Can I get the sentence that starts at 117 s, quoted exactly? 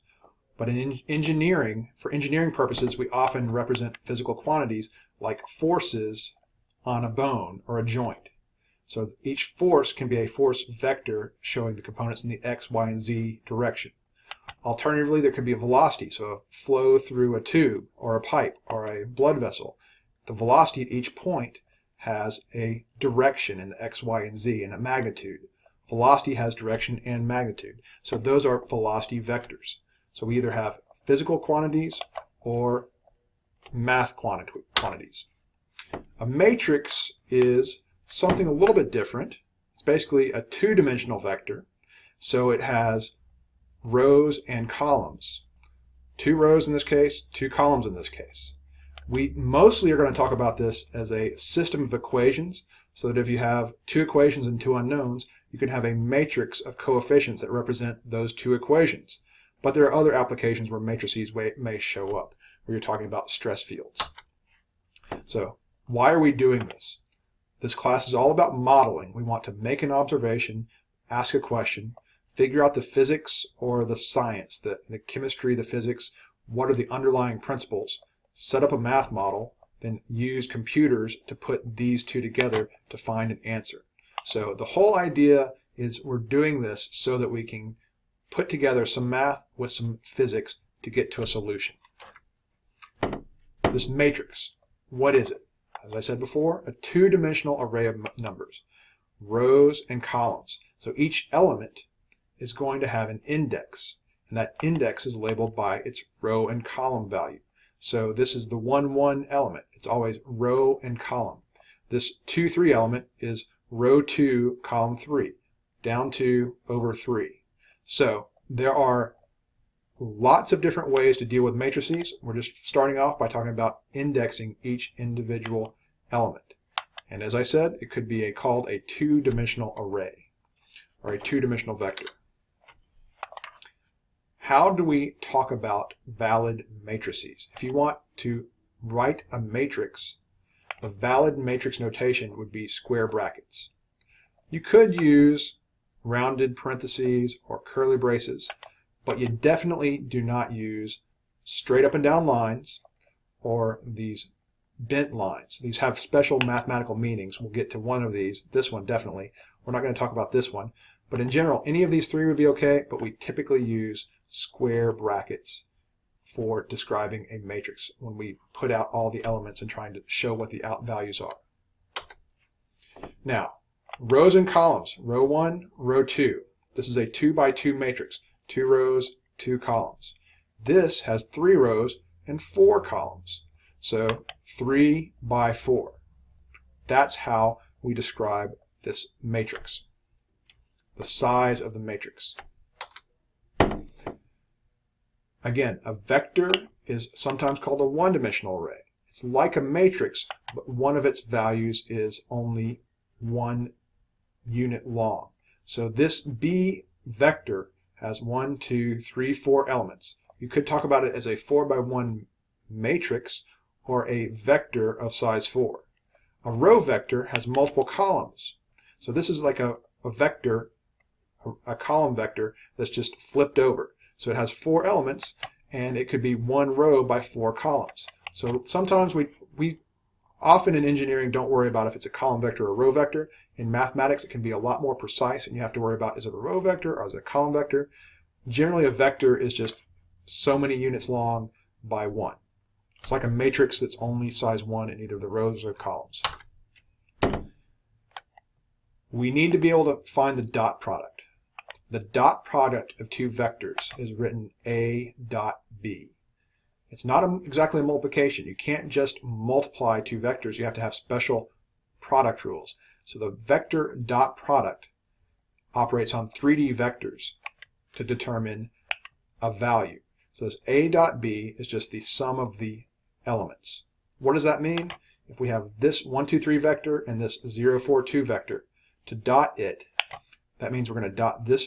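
So there are lots of different ways to deal with matrices.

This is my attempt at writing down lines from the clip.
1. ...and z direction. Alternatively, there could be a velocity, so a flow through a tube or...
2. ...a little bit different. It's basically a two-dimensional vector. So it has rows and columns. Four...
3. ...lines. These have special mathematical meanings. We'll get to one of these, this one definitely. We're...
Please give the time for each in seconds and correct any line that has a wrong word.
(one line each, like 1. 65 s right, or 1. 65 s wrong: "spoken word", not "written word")
1. 12 s right
2. 38 s wrong: "Two", not "Four"
3. 155 s right.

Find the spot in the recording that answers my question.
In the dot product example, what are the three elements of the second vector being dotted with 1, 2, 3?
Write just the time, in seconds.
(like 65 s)
277 s.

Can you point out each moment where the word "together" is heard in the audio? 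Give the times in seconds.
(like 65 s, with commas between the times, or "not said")
82 s, 88 s.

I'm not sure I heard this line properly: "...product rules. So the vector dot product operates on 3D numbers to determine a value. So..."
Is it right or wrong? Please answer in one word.
wrong.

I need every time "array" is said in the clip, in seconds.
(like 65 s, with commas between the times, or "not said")
97 s, 129 s, 198 s.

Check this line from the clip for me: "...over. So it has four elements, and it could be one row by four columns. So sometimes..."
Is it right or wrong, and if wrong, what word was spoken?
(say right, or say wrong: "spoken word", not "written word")
right.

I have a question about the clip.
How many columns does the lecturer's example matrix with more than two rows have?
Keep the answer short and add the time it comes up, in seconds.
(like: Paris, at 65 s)
4, at 181 s.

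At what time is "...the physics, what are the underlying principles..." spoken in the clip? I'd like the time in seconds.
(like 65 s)
75 s.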